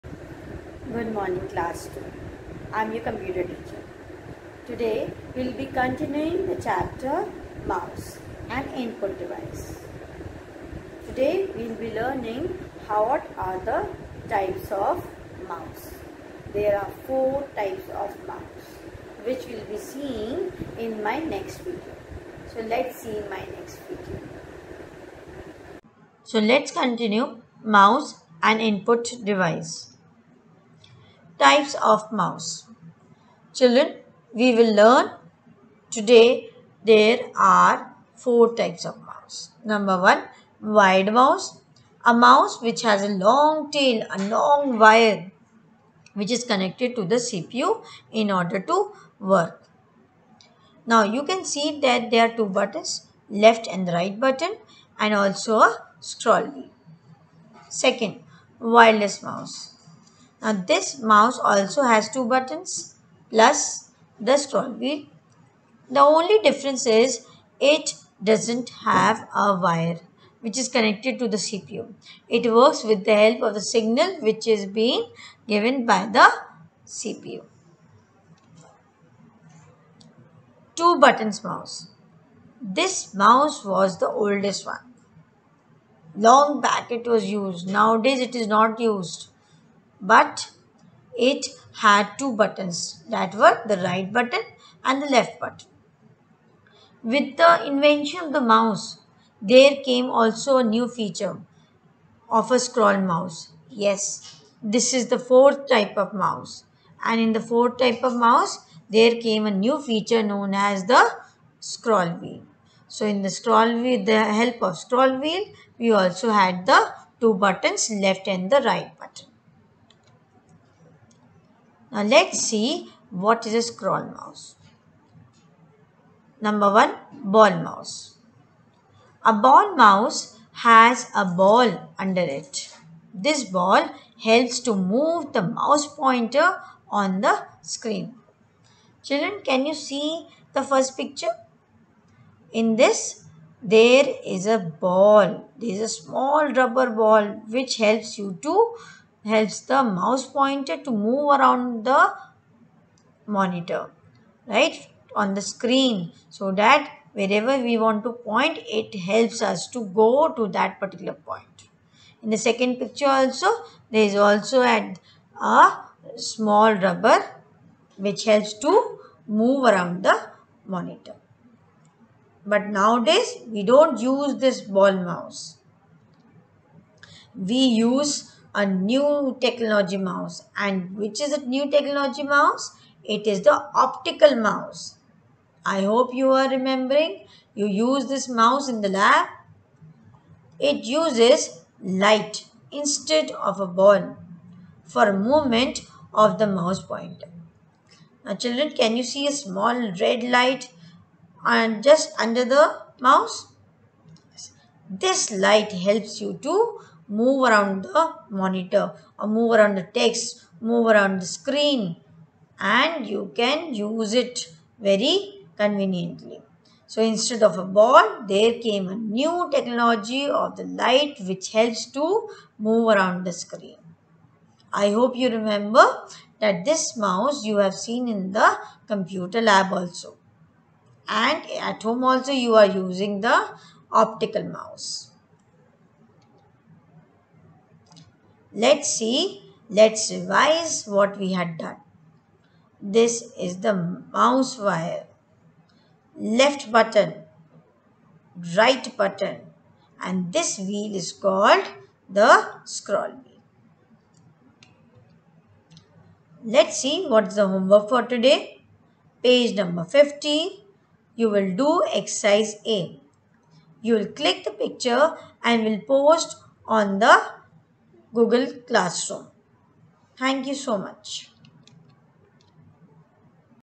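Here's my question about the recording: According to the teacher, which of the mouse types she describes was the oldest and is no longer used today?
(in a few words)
Two buttons mouse.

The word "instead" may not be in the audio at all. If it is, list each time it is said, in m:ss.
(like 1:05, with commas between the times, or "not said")
3:12, 3:37.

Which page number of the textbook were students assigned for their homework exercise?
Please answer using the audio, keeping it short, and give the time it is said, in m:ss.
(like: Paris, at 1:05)
50, at 4:19.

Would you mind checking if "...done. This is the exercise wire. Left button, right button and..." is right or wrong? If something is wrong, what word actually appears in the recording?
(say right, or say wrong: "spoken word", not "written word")
wrong: "mouse", not "exercise".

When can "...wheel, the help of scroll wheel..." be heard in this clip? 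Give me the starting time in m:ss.
1:53.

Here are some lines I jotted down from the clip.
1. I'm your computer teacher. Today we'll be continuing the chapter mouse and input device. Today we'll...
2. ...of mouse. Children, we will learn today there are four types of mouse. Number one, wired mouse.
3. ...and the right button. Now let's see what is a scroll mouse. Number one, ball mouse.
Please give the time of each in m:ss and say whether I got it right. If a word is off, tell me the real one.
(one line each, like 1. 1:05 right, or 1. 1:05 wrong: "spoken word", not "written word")
1. 0:02 right
2. 0:31 right
3. 1:58 right.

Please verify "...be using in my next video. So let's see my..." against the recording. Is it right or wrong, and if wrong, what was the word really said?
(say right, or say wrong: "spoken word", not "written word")
wrong: "seeing", not "using".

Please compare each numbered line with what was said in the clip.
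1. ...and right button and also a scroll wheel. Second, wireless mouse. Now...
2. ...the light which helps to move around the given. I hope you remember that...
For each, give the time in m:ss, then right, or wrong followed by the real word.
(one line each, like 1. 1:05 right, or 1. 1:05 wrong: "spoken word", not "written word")
1. 0:53 right
2. 3:40 wrong: "screen", not "given".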